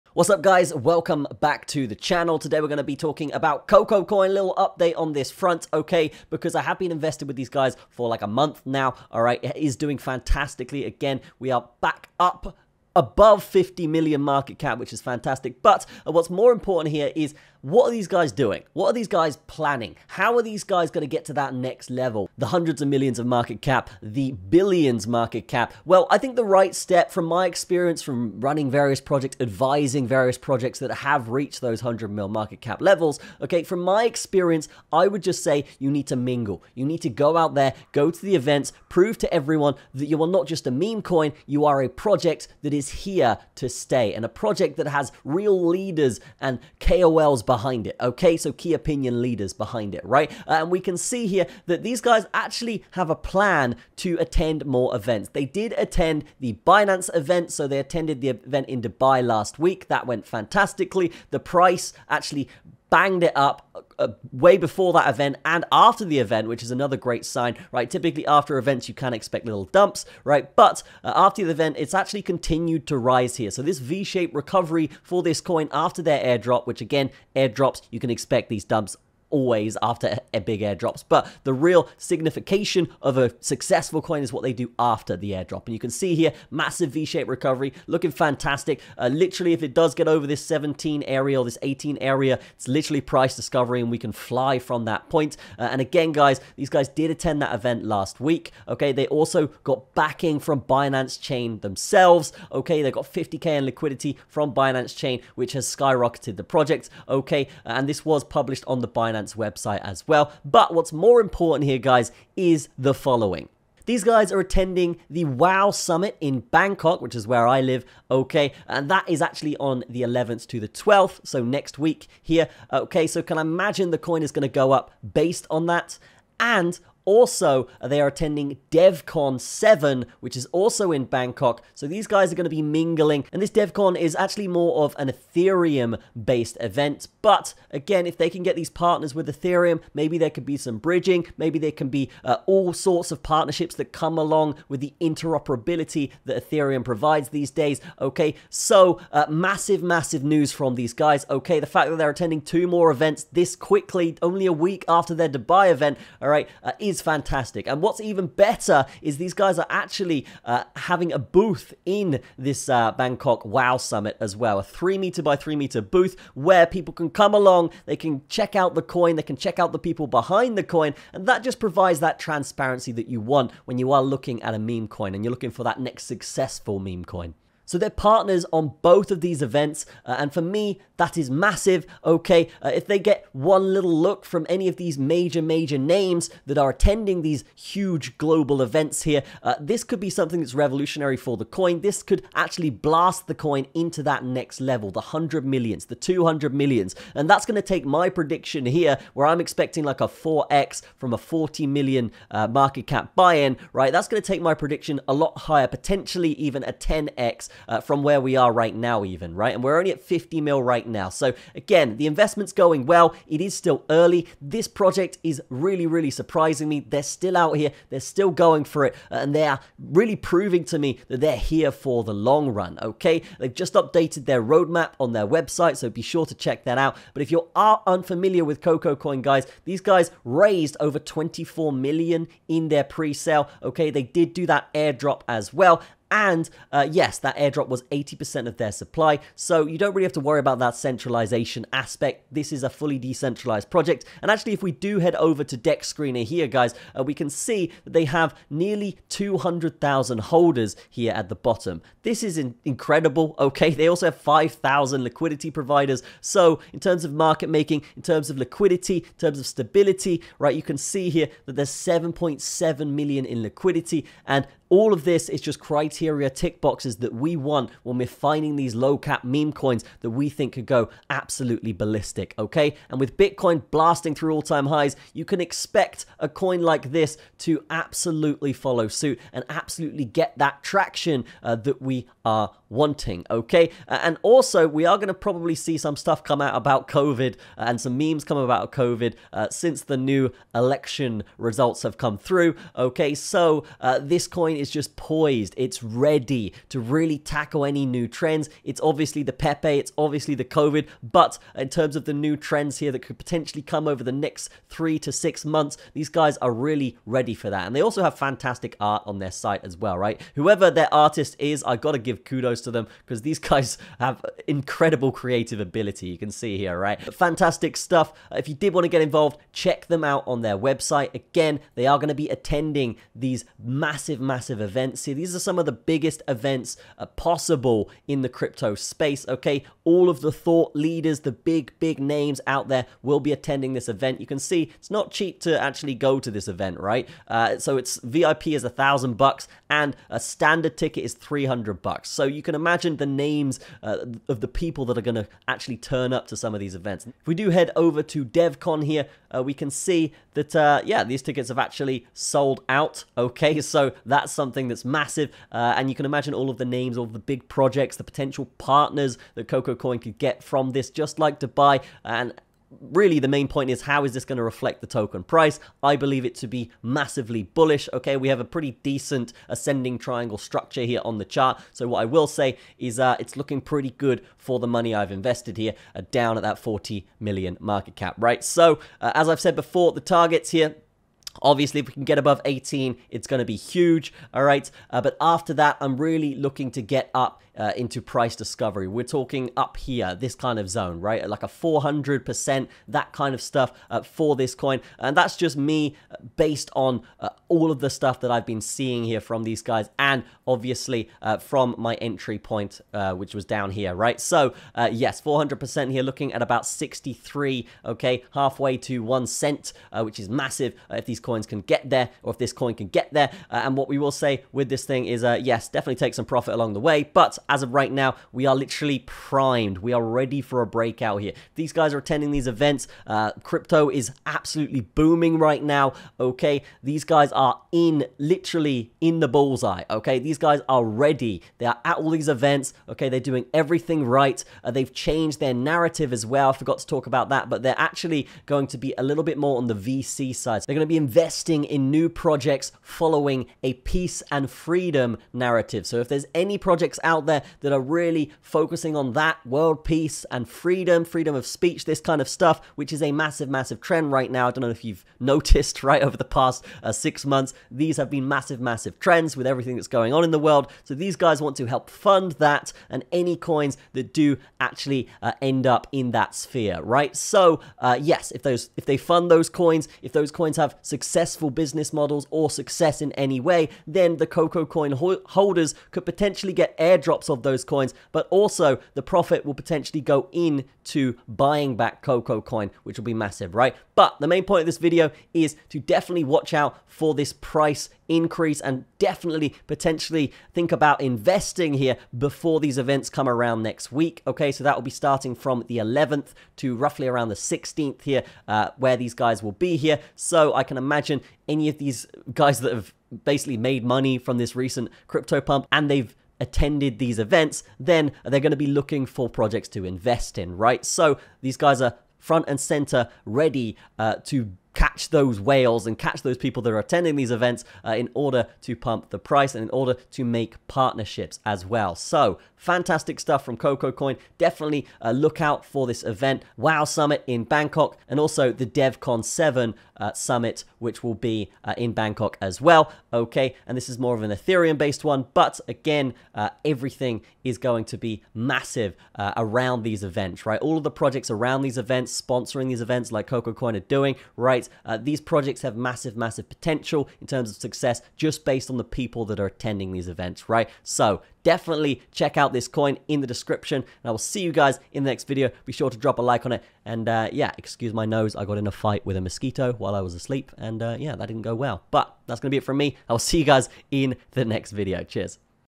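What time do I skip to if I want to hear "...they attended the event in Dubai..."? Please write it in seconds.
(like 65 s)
57 s.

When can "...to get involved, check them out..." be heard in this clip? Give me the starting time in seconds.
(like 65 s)
318 s.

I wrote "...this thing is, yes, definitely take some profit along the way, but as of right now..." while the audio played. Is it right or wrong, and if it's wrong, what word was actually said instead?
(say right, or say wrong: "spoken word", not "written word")
right.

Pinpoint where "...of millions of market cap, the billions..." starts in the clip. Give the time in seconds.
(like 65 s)
22 s.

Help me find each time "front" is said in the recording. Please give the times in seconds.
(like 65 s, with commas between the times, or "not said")
5 s, 512 s.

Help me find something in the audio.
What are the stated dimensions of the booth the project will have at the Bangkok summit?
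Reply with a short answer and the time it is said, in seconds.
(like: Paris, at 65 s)
3 meters by 3 meters, at 164 s.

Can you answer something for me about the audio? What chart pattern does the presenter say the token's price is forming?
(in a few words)
ascending triangle.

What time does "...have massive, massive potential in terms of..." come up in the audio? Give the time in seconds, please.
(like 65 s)
545 s.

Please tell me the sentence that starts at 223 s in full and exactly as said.
They've just updated their roadmap on their website, so be sure to check that out.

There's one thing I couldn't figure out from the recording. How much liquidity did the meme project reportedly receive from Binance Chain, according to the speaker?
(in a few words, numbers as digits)
50K.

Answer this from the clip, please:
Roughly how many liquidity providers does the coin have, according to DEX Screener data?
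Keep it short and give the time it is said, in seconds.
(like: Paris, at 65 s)
5,000, at 254 s.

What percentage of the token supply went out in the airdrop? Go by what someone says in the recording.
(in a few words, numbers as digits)
80%.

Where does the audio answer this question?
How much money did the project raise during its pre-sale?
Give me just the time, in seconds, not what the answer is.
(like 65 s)
230 s.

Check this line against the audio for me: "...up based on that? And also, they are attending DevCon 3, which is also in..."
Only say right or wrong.
wrong.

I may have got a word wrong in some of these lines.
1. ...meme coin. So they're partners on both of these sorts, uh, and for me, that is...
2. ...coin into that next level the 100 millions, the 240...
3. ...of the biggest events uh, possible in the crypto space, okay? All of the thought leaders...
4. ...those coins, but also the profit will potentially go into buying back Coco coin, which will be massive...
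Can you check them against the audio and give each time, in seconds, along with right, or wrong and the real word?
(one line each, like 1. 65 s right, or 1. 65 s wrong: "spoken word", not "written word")
1. 176 s wrong: "events", not "sorts"
2. 193 s wrong: "200", not "240"
3. 325 s right
4. 477 s right.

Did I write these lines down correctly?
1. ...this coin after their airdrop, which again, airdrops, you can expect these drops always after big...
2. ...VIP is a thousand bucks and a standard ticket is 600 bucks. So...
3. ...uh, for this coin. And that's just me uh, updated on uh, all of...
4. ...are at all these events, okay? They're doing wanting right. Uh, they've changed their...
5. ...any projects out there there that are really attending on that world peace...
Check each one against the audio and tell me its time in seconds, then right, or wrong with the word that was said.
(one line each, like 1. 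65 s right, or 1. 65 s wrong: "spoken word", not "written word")
1. 75 s wrong: "dumps", not "drops"
2. 338 s wrong: "300", not "600"
3. 393 s wrong: "based", not "updated"
4. 431 s wrong: "everything", not "wanting"
5. 446 s wrong: "focusing", not "attending".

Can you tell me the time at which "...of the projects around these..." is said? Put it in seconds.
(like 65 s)
540 s.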